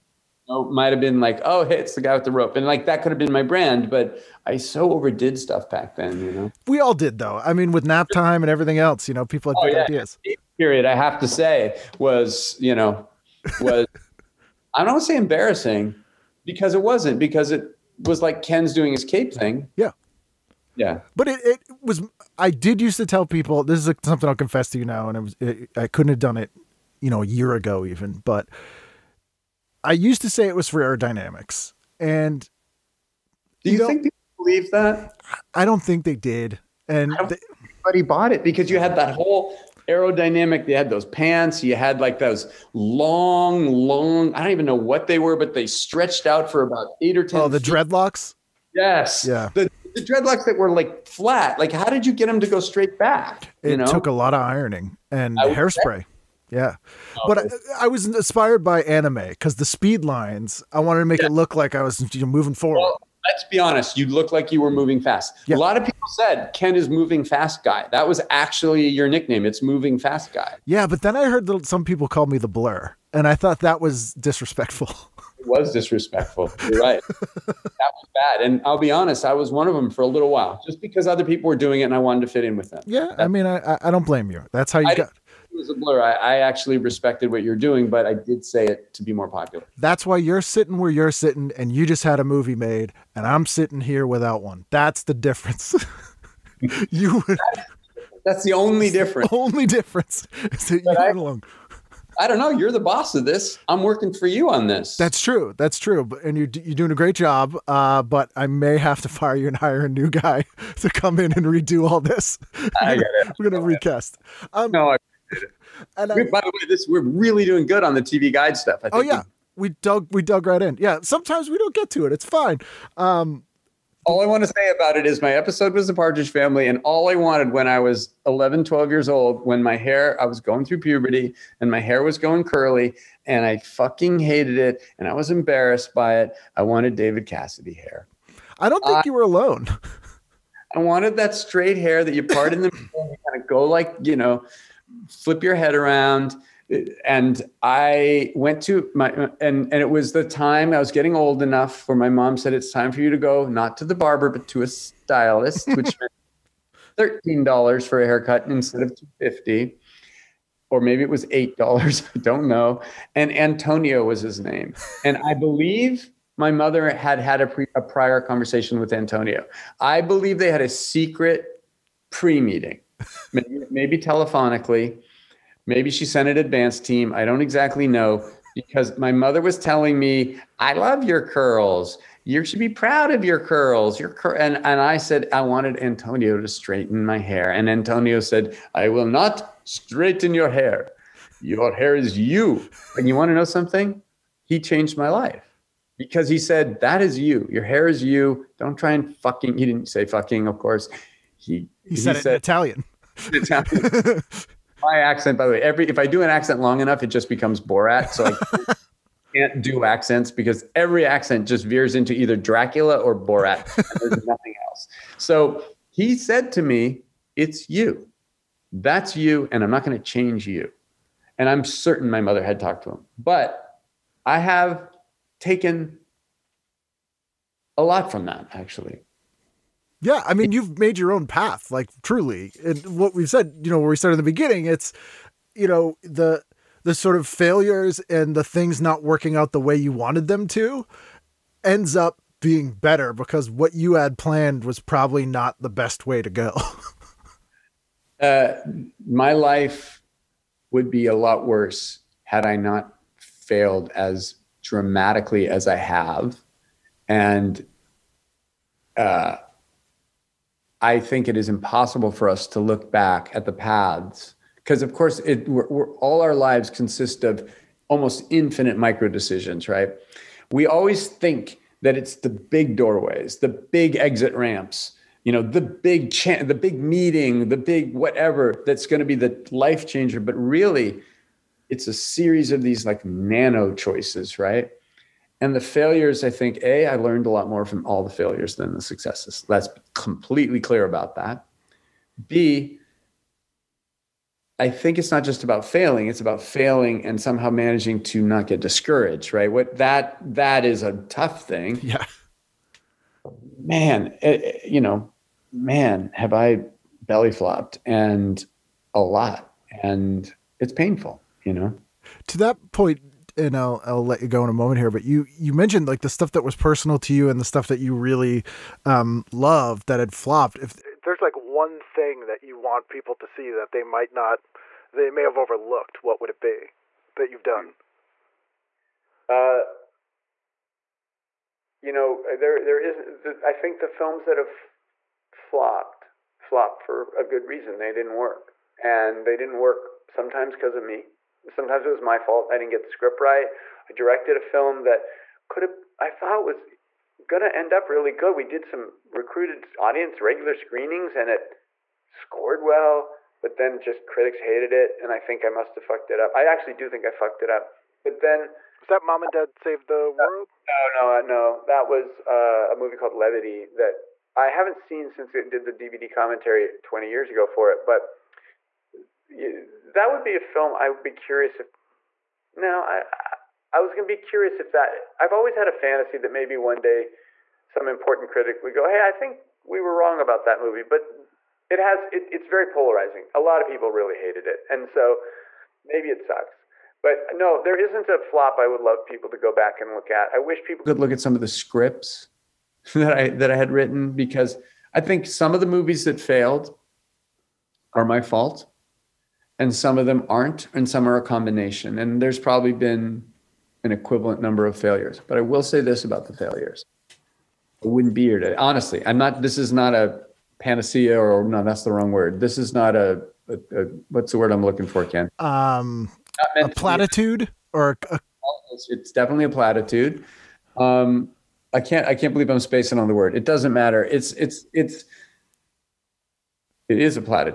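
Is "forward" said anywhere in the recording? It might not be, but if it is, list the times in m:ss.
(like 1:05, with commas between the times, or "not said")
1:02.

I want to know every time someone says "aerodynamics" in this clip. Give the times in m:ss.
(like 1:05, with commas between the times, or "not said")
0:30, 0:39.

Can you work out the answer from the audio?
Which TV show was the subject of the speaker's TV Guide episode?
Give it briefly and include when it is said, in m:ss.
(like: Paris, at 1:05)
The Partridge Family, at 2:05.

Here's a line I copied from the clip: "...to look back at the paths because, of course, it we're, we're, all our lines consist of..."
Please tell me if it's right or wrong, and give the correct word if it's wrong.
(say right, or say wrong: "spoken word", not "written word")
wrong: "lives", not "lines".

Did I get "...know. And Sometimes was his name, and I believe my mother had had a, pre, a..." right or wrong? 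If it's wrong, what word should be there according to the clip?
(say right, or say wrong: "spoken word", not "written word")
wrong: "Antonio", not "Sometimes".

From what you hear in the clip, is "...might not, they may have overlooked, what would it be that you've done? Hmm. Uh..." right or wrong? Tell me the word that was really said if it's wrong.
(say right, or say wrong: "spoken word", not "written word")
right.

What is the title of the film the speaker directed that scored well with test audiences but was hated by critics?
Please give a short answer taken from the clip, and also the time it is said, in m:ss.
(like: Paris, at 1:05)
Levity, at 6:03.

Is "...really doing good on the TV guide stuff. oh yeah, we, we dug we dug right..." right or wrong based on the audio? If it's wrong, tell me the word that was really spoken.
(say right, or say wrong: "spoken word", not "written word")
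right.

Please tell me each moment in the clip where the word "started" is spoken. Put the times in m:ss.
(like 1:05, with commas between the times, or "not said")
3:53.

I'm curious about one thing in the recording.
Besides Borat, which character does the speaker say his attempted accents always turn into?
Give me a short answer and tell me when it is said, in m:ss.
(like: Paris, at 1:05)
Dracula, at 3:32.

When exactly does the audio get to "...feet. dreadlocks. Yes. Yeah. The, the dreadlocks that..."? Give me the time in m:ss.
0:47.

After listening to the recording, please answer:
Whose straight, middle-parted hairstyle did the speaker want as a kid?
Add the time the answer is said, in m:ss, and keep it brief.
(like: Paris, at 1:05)
David Cassidy, at 2:16.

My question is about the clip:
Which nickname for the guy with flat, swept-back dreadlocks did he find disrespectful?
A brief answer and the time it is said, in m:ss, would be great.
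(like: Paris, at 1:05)
The blur, at 1:12.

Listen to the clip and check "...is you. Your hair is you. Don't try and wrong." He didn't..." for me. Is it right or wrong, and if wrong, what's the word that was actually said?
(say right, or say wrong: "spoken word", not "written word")
wrong: "fucking", not "wrong".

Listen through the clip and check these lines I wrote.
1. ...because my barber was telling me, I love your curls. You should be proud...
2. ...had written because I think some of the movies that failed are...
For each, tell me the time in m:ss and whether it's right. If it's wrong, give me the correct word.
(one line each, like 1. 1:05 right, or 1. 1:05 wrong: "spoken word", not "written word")
1. 2:58 wrong: "mother", not "barber"
2. 6:33 right.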